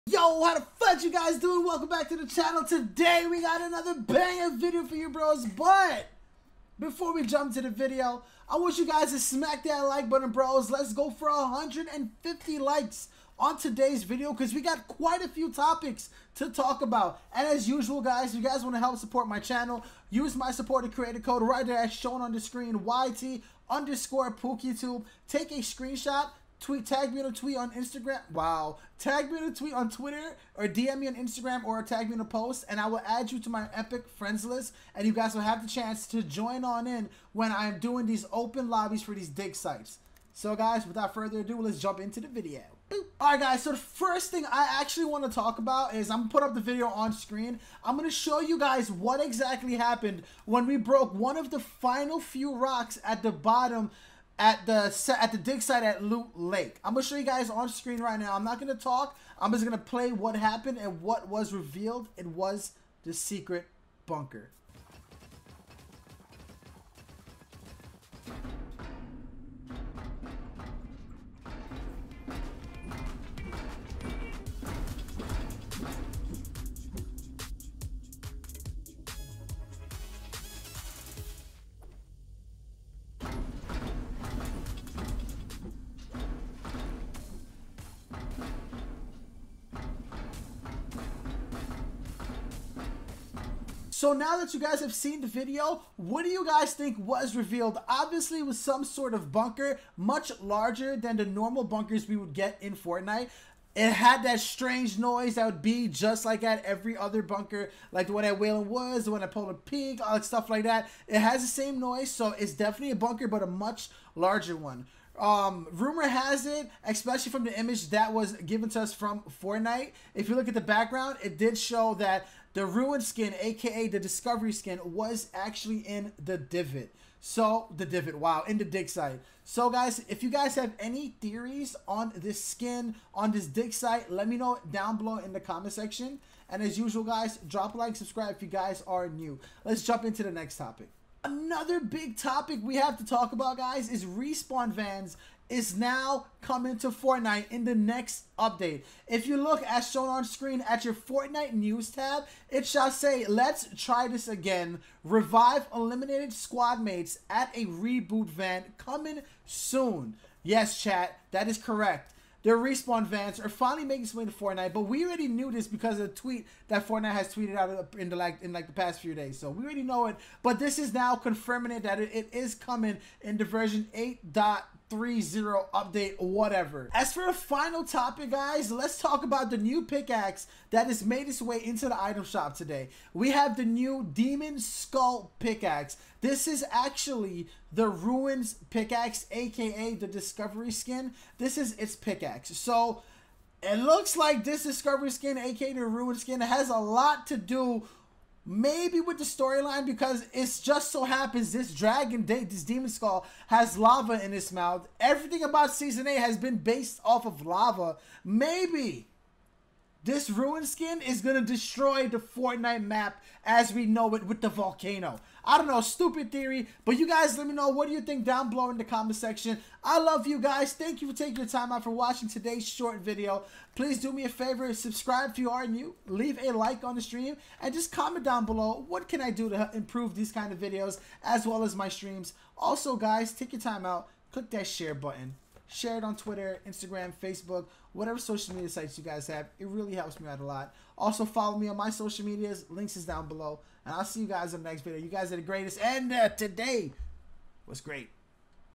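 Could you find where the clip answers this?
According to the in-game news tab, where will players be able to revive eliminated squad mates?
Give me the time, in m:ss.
2:37.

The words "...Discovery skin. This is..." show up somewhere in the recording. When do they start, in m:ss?
3:10.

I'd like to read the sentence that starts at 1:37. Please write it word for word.
Obviously it was some sort of bunker, much larger than the normal bunkers we would get in Fortnite.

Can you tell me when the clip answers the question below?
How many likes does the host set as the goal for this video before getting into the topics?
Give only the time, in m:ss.
0:11.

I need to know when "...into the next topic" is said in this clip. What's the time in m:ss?
2:20.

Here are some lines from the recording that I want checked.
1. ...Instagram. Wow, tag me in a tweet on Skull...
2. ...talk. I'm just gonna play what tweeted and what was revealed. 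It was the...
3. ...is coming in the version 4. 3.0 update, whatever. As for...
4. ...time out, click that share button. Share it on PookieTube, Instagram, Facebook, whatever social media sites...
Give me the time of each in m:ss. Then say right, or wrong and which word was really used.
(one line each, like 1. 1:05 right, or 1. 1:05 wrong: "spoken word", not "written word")
1. 0:27 wrong: "Twitter", not "Skull"
2. 0:58 wrong: "happened", not "tweeted"
3. 2:52 wrong: "8", not "4"
4. 3:53 wrong: "Twitter", not "PookieTube".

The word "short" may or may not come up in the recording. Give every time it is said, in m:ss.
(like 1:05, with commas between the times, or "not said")
3:42.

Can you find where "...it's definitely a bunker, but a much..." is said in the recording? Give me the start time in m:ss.
1:52.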